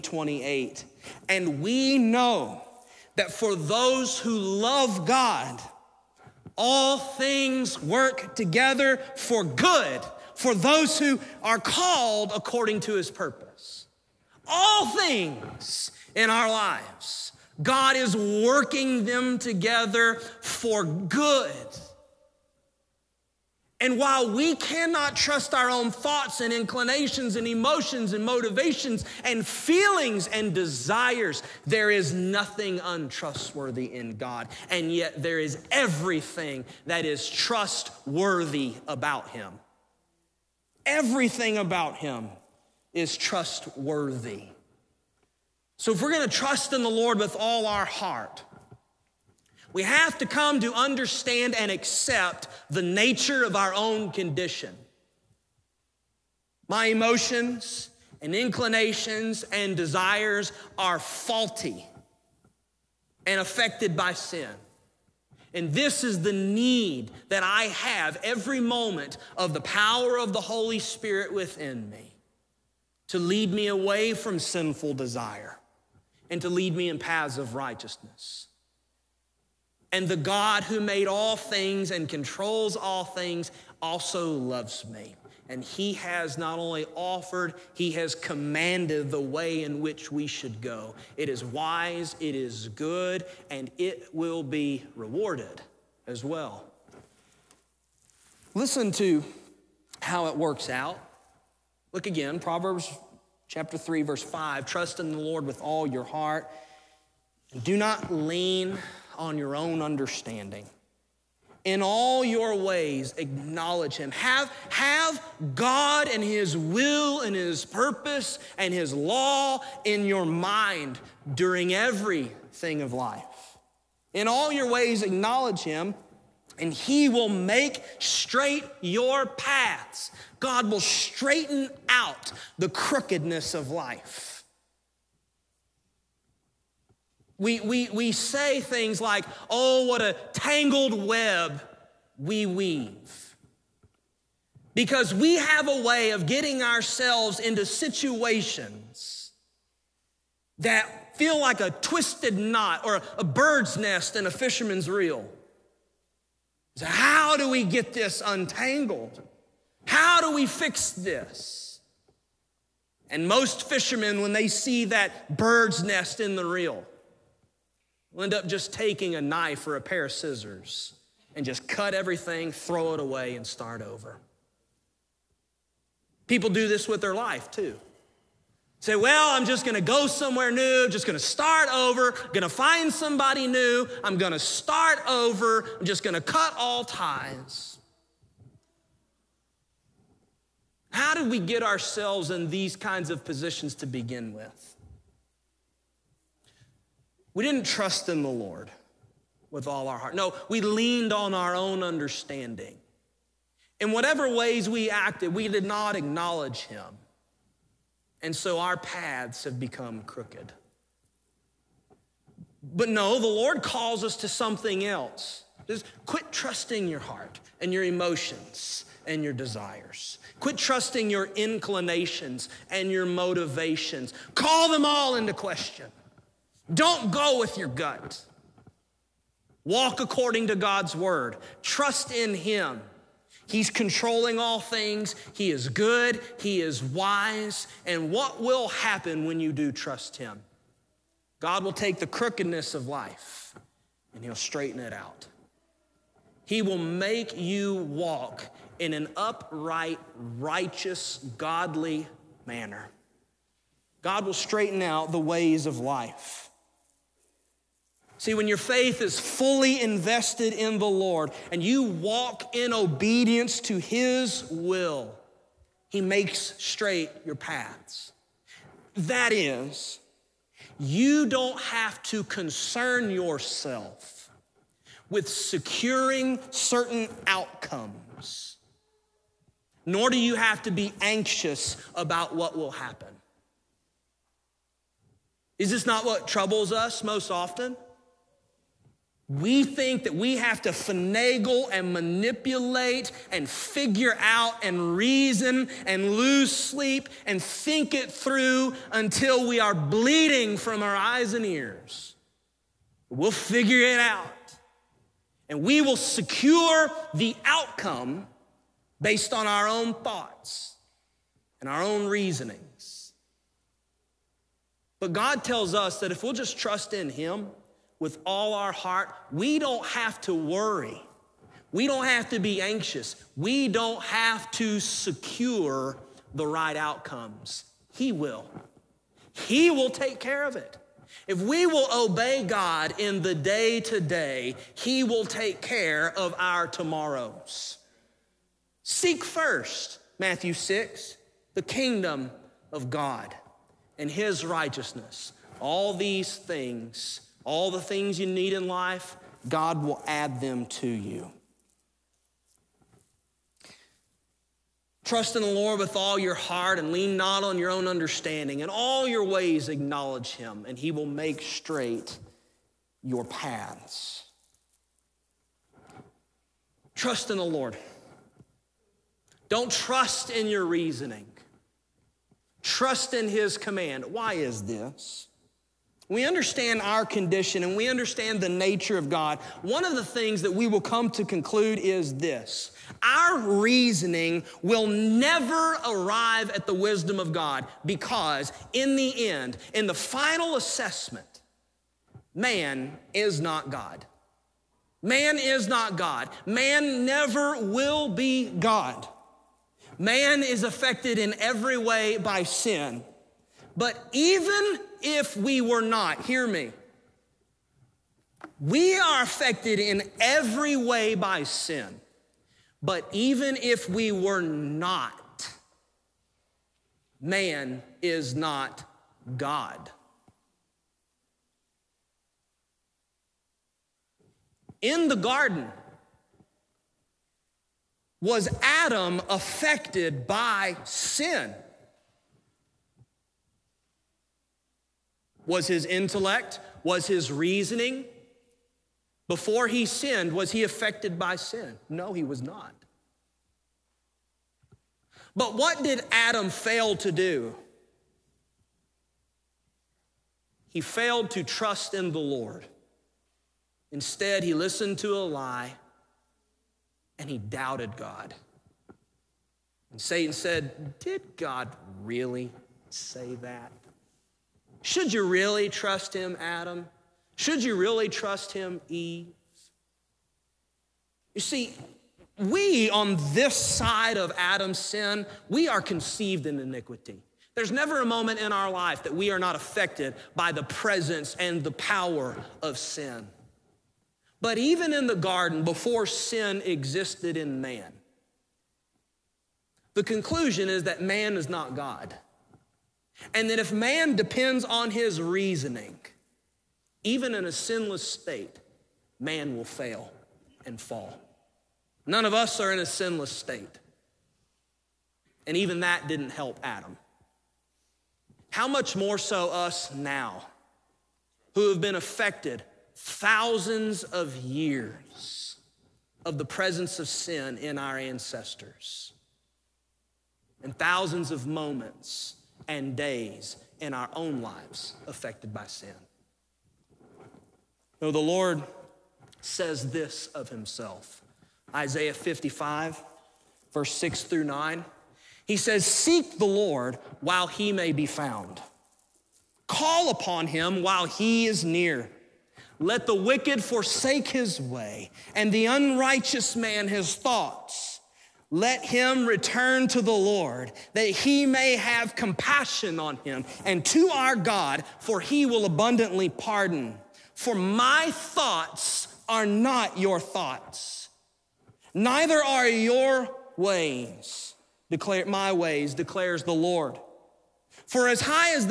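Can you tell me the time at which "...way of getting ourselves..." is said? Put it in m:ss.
2:25.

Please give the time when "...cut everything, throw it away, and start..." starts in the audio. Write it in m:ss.
2:51.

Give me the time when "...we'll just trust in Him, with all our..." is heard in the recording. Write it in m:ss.
5:16.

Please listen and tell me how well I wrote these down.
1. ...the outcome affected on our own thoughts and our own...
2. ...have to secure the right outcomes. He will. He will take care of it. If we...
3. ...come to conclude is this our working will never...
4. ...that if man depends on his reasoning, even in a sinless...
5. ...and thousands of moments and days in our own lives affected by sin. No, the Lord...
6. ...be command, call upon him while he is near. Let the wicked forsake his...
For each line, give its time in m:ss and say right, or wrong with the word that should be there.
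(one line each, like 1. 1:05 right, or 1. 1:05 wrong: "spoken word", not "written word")
1. 5:07 wrong: "based", not "affected"
2. 5:24 right
3. 6:20 wrong: "reasoning", not "working"
4. 8:13 right
5. 8:40 right
6. 8:57 wrong: "found", not "command".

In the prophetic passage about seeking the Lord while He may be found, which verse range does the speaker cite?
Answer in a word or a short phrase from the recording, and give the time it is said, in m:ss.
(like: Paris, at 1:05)
6 through 9, at 8:53.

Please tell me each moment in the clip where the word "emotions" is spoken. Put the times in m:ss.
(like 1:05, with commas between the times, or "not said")
0:27, 0:56, 3:37.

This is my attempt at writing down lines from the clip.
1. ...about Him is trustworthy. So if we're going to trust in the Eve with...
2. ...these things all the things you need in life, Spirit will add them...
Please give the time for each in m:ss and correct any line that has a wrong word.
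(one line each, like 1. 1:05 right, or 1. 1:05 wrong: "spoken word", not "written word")
1. 0:41 wrong: "Lord", not "Eve"
2. 5:45 wrong: "God", not "Spirit".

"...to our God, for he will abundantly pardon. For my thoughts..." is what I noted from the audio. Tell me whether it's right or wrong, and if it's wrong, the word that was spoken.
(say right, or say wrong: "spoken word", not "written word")
right.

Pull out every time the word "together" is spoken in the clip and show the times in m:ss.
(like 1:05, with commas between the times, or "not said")
0:08, 0:19.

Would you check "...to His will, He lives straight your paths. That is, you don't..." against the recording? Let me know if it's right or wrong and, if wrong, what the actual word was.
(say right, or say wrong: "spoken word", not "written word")
wrong: "makes", not "lives".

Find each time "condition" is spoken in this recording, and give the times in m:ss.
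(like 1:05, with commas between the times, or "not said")
0:54, 6:17.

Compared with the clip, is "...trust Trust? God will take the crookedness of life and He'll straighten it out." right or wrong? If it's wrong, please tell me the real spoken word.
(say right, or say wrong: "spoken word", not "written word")
wrong: "Him", not "Trust".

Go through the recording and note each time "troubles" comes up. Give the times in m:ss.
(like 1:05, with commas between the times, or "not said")
4:46.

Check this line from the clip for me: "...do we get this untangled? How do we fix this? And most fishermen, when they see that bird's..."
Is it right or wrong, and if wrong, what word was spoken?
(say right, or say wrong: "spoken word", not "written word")
right.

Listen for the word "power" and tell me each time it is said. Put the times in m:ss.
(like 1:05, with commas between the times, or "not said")
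1:09, 8:01.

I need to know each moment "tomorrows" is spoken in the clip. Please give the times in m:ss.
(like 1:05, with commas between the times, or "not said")
5:36.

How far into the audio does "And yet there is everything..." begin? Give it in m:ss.
0:34.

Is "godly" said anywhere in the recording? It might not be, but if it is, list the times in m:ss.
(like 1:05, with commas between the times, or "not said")
4:11.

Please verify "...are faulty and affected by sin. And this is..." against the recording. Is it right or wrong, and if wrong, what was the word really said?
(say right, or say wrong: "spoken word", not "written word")
right.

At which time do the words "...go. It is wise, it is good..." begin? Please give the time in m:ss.
1:30.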